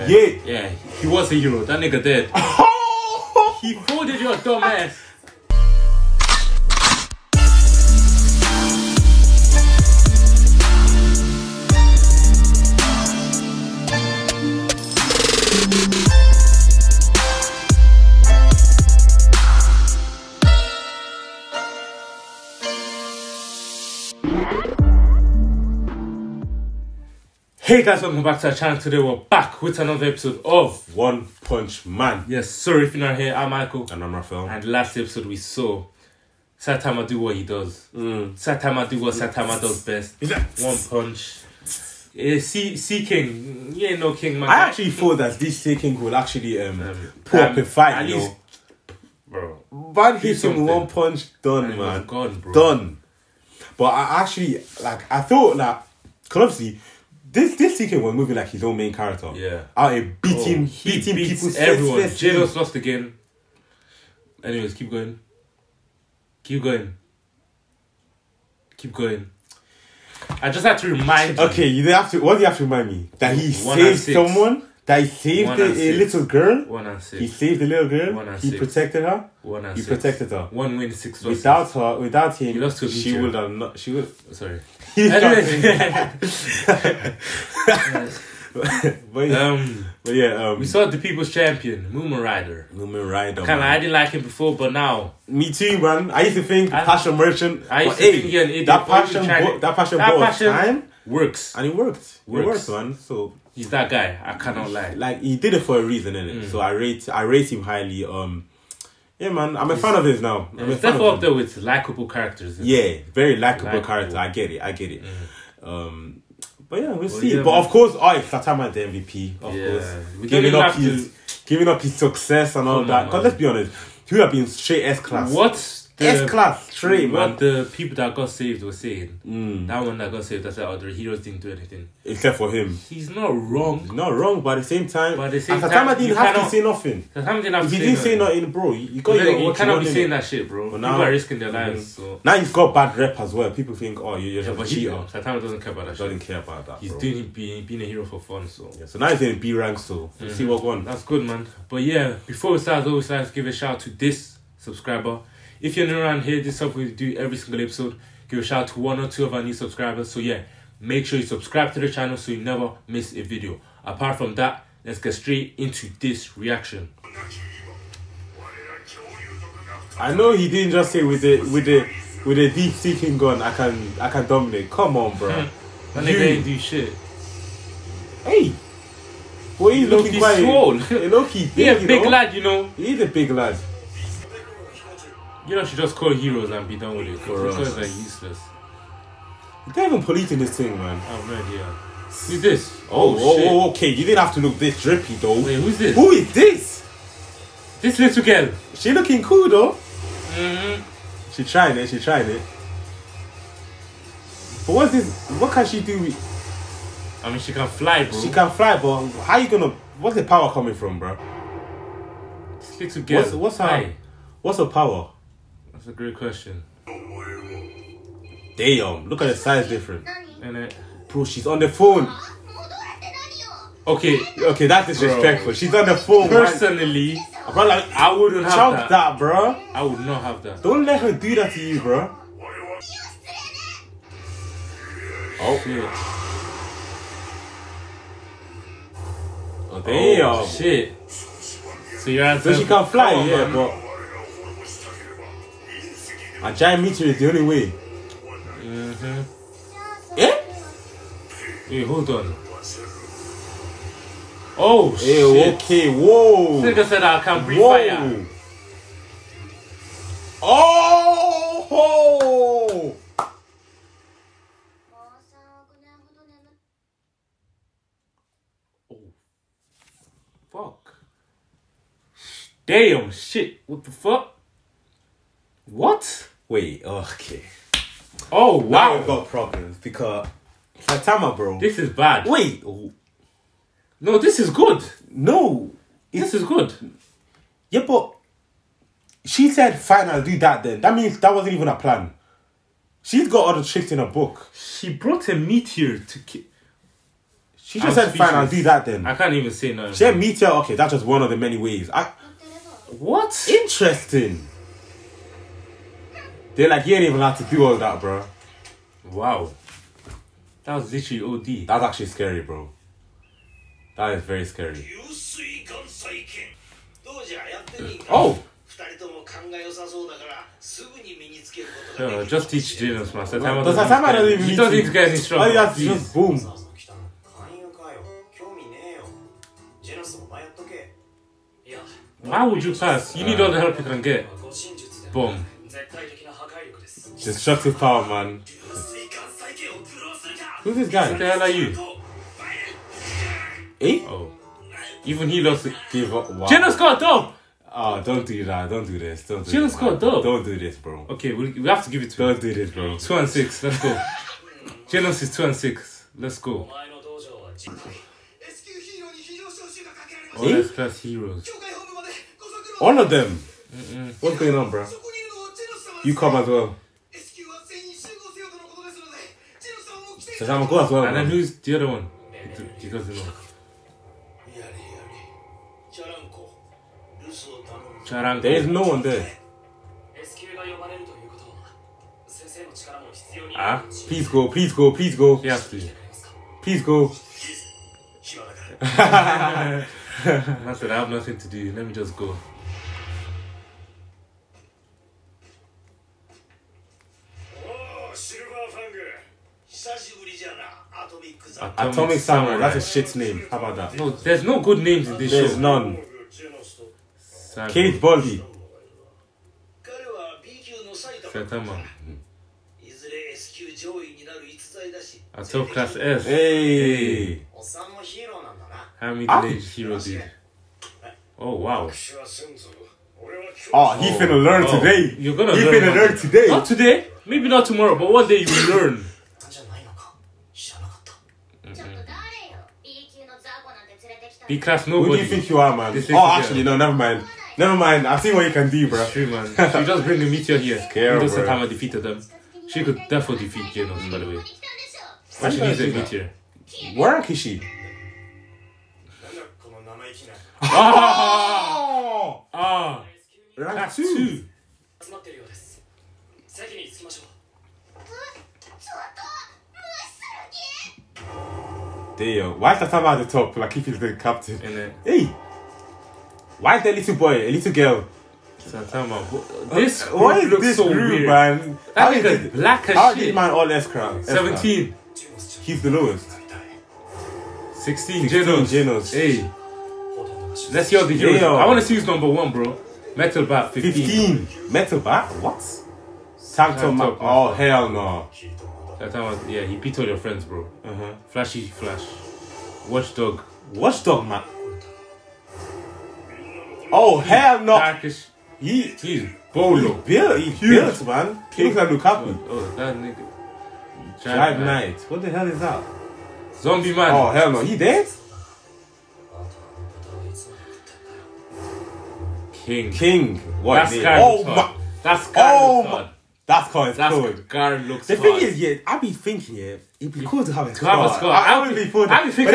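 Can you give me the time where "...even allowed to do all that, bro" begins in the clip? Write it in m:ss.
5:07.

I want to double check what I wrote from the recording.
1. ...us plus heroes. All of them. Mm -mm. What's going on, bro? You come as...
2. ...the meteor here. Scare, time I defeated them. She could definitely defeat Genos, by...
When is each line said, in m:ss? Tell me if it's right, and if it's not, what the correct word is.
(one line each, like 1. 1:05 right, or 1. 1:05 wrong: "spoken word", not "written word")
1. 6:00 right
2. 7:20 right.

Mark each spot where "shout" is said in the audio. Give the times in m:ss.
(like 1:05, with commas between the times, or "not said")
2:33, 2:38.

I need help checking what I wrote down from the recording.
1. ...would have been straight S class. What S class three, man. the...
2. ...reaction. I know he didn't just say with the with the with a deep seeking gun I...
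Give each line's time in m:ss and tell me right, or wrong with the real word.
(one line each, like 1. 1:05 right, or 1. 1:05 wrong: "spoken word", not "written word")
1. 2:04 right
2. 2:46 right.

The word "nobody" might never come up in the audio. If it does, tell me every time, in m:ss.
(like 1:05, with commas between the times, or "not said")
7:14.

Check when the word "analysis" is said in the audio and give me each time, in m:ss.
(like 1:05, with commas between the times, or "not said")
not said.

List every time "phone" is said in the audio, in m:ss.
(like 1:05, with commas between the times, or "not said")
3:41, 3:45.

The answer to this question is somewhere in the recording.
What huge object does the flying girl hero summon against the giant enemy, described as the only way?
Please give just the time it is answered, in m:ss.
4:06.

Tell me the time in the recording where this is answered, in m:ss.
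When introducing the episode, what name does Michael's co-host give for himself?
0:34.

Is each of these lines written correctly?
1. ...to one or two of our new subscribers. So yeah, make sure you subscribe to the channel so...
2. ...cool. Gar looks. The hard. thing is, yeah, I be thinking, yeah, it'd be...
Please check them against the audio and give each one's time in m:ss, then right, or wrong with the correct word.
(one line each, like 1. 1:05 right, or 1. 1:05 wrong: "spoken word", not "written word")
1. 2:38 right
2. 8:37 right.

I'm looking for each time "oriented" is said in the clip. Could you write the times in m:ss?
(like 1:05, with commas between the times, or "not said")
not said.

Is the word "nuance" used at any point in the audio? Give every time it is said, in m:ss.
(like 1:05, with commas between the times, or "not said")
not said.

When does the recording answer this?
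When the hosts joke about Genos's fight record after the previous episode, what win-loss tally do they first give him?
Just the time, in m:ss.
1:16.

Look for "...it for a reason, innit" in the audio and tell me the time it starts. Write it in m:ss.
1:45.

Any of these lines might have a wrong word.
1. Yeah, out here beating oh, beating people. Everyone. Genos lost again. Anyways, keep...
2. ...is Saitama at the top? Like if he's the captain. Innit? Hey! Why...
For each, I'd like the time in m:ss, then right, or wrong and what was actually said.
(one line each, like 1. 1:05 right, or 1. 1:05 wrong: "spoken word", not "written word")
1. 0:59 right
2. 7:42 right.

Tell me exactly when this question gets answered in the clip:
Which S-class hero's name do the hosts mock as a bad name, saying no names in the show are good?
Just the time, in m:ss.
6:41.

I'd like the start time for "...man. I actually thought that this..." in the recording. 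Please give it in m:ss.
0:44.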